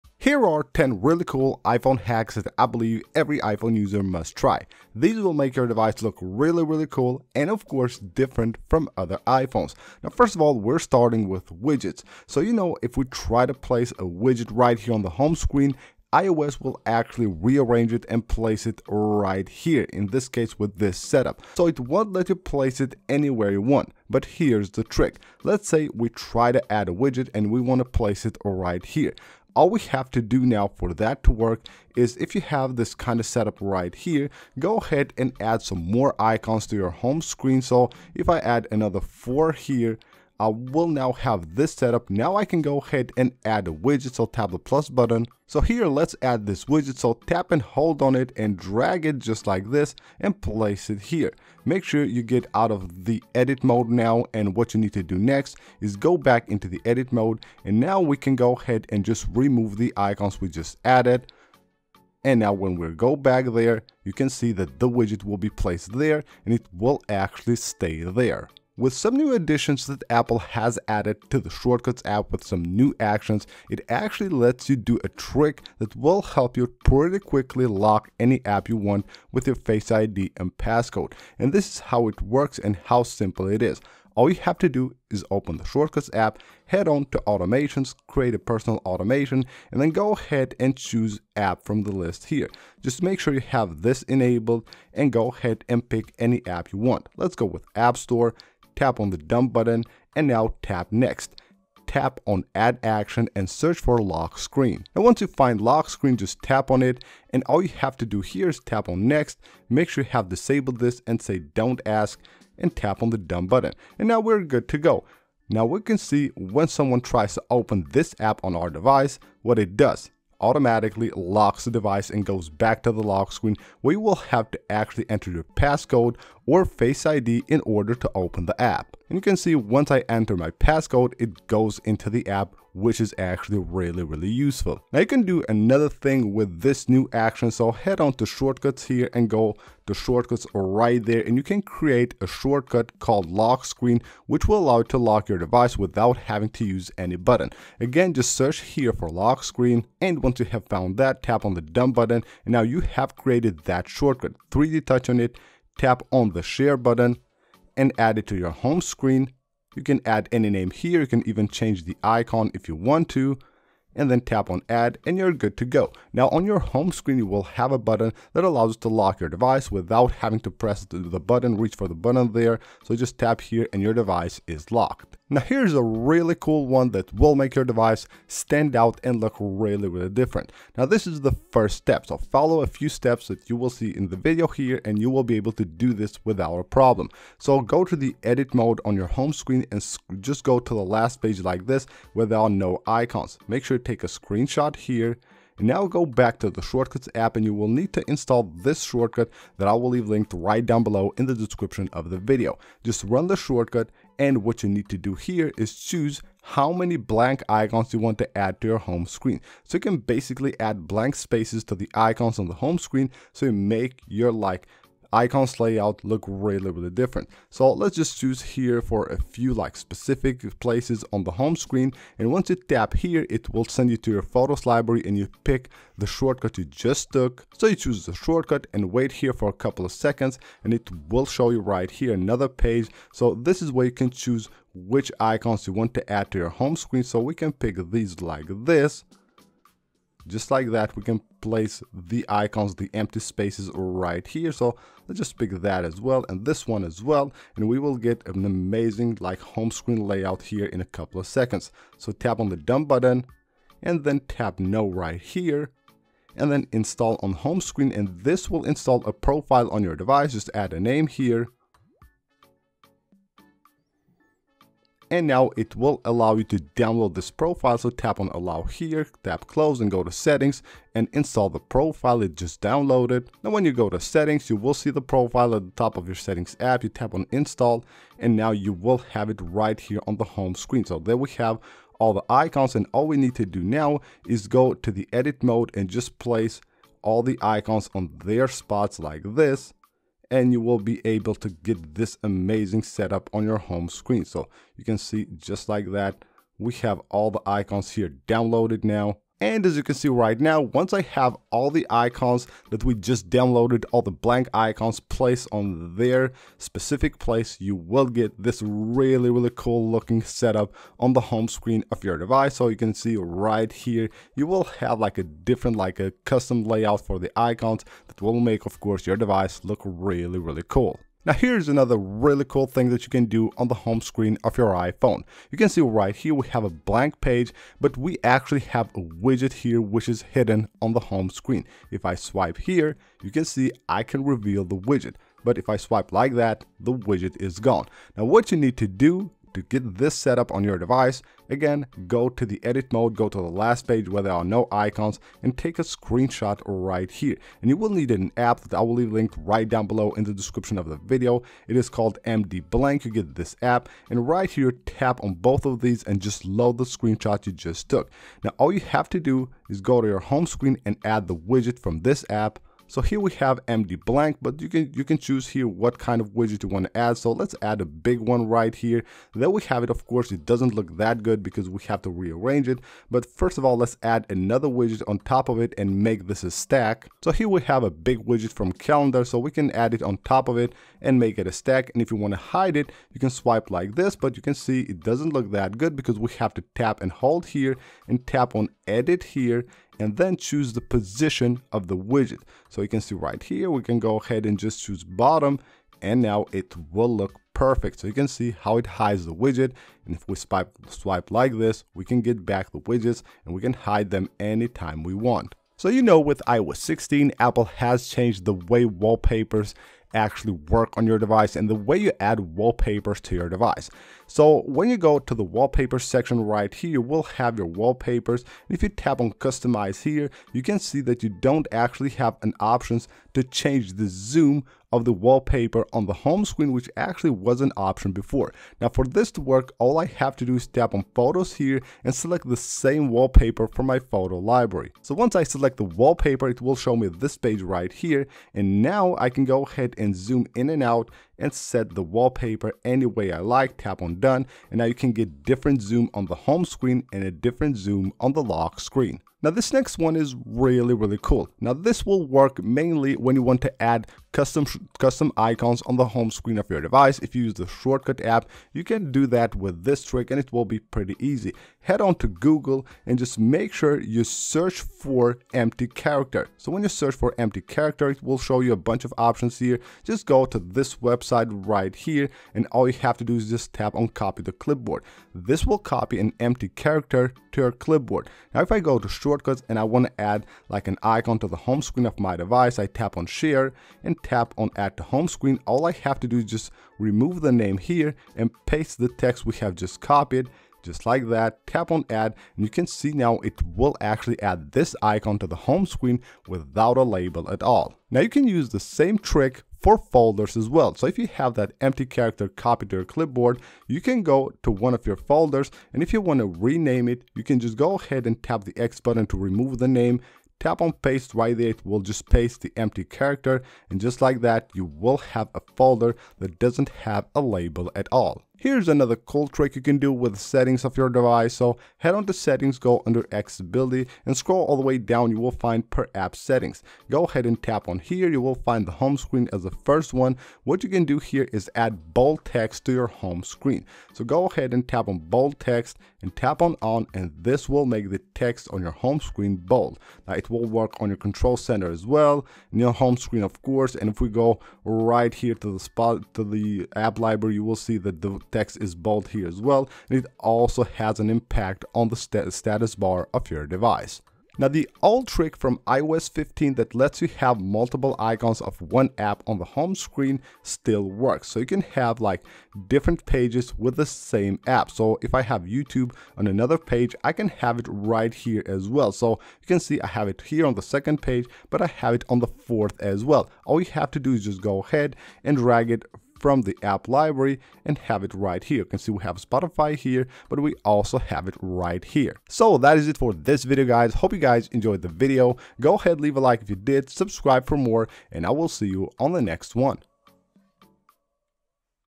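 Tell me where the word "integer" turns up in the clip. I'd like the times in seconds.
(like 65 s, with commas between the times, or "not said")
not said.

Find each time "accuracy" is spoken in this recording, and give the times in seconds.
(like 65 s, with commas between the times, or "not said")
not said.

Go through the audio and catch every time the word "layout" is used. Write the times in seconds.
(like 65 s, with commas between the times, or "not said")
215 s, 250 s, 316 s.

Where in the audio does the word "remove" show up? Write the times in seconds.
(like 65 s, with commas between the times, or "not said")
59 s, 486 s, 509 s.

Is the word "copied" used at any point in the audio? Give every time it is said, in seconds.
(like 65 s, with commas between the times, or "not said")
490 s, 502 s.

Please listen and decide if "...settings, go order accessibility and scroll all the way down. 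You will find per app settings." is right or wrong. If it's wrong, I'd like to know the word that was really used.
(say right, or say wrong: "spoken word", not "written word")
wrong: "under", not "order".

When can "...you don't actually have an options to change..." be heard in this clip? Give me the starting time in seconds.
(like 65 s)
421 s.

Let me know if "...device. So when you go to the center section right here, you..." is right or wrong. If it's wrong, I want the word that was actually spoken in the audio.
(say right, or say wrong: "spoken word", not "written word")
wrong: "wallpaper", not "center".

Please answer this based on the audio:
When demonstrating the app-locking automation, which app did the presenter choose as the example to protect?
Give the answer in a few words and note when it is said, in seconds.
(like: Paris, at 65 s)
App Store, at 97 s.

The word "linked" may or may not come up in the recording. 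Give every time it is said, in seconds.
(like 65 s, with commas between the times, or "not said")
200 s, 349 s.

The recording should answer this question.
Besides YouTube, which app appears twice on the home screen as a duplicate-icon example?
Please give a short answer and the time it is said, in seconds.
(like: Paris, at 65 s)
Spotify, at 579 s.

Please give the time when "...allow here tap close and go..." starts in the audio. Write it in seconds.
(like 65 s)
268 s.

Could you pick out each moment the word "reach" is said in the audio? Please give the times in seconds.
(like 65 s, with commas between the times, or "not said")
171 s.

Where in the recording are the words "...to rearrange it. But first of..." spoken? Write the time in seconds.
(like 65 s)
372 s.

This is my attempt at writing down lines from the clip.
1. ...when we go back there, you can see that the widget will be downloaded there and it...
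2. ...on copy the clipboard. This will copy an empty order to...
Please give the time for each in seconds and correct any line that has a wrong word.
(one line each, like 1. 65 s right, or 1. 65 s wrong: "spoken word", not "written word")
1. 62 s wrong: "placed", not "downloaded"
2. 473 s wrong: "character", not "order".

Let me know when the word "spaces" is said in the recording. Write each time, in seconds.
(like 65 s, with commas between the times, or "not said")
211 s, 243 s.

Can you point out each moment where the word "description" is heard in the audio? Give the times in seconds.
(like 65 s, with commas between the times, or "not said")
201 s, 350 s.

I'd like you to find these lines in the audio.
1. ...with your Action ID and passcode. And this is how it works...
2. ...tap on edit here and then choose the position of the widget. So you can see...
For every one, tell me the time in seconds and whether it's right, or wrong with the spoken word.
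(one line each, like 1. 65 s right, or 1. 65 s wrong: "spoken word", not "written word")
1. 79 s wrong: "Face", not "Action"
2. 388 s right.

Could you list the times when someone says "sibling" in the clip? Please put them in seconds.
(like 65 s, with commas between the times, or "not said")
not said.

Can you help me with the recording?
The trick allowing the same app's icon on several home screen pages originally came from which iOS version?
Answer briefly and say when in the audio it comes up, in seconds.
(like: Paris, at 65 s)
iOS 15, at 555 s.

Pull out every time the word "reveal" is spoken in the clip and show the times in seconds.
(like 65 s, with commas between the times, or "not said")
334 s.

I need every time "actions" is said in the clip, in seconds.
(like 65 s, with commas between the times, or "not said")
73 s, 102 s, 137 s.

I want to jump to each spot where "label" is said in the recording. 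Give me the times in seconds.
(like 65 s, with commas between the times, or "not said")
497 s, 517 s.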